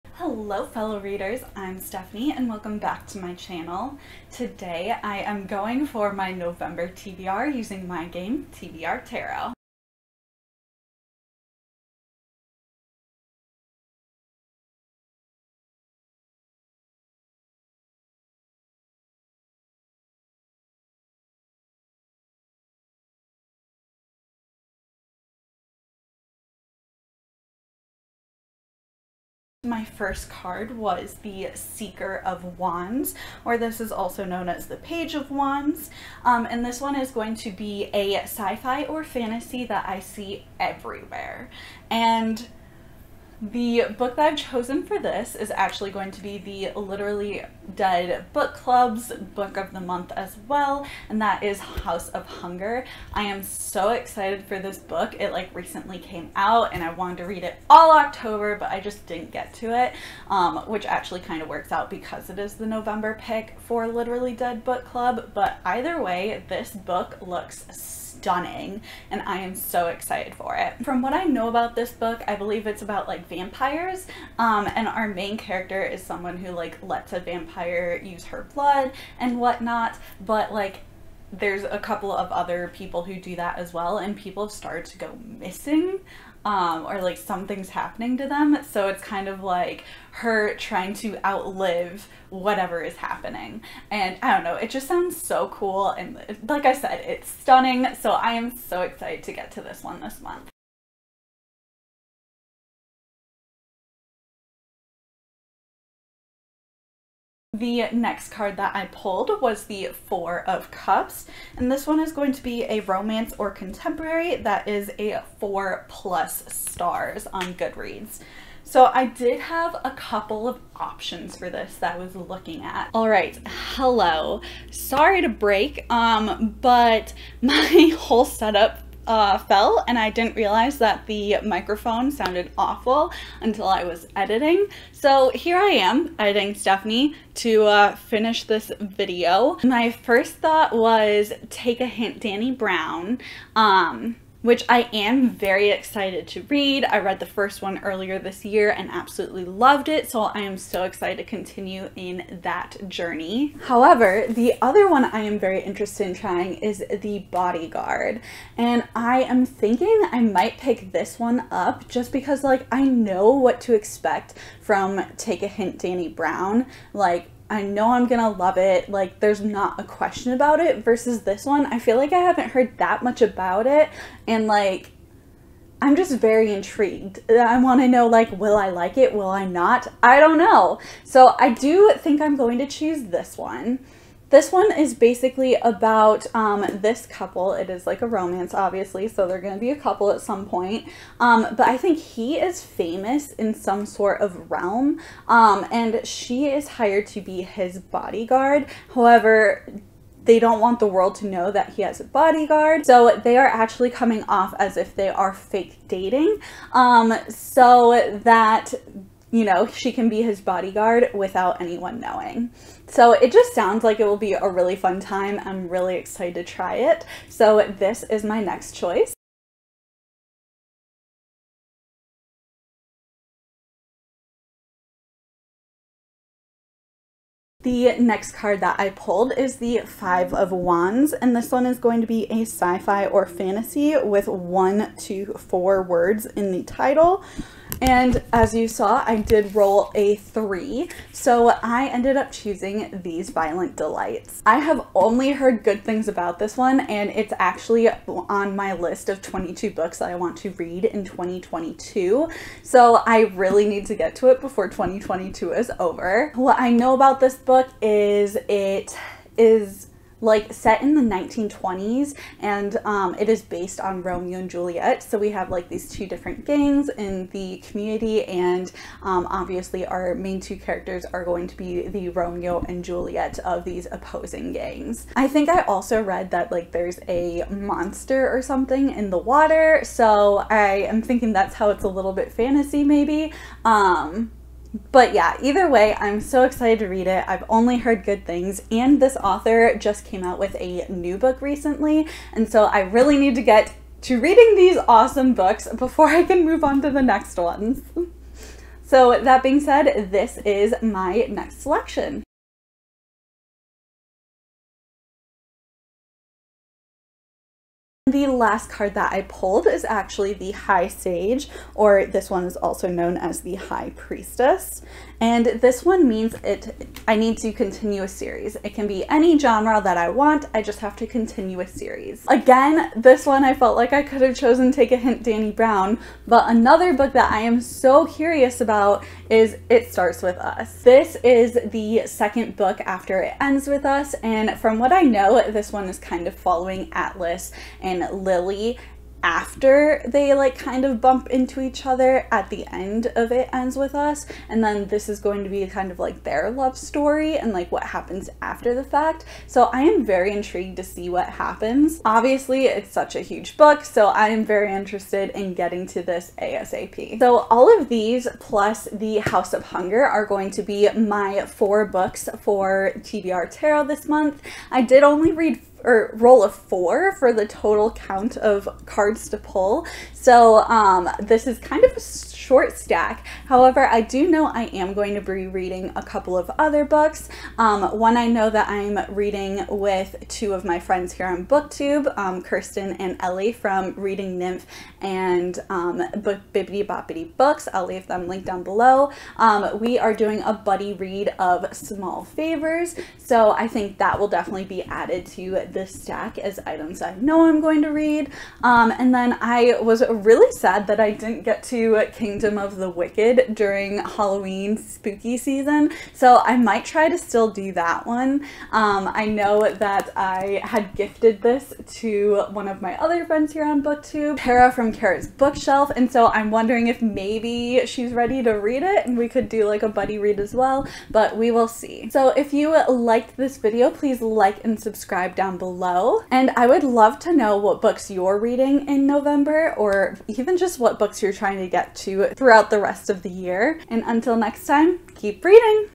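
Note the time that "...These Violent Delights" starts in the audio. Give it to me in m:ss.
4:03.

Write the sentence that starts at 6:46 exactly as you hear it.
So I might try to still do that one.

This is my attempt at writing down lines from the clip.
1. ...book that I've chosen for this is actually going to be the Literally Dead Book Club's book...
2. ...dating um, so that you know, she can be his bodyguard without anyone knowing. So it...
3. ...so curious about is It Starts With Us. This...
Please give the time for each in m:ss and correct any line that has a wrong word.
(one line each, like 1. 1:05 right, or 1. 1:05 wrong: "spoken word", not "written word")
1. 0:43 right
2. 3:25 right
3. 5:27 right.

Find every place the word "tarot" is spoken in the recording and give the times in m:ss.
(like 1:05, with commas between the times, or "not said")
0:09, 6:03.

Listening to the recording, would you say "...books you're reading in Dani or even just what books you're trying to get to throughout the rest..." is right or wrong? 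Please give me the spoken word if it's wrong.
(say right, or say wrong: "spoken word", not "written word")
wrong: "November", not "Dani".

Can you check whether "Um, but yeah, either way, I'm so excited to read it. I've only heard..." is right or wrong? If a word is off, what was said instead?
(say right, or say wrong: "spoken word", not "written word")
right.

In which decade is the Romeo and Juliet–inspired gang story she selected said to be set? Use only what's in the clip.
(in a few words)
1920s.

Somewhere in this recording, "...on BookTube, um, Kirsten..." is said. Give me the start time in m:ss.
6:21.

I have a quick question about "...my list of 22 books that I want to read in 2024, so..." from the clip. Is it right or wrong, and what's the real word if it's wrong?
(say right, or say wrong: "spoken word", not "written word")
wrong: "2022", not "2024".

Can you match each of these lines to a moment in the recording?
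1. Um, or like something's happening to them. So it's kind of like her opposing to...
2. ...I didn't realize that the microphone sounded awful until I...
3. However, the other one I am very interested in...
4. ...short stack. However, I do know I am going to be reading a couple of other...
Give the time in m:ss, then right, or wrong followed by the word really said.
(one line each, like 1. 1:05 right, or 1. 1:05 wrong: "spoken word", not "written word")
1. 1:26 wrong: "trying", not "opposing"
2. 2:09 right
3. 2:33 right
4. 6:11 right.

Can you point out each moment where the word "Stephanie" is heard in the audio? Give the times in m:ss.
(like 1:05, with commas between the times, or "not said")
0:01, 2:16.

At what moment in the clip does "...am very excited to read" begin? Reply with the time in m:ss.
2:24.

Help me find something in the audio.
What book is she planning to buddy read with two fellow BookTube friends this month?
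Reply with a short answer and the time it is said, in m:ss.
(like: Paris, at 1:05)
Small Favors, at 6:31.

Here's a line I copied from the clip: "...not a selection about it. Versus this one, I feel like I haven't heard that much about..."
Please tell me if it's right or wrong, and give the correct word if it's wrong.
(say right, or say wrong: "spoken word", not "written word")
wrong: "question", not "selection".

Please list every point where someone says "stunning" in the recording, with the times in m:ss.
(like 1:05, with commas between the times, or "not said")
1:08, 1:37.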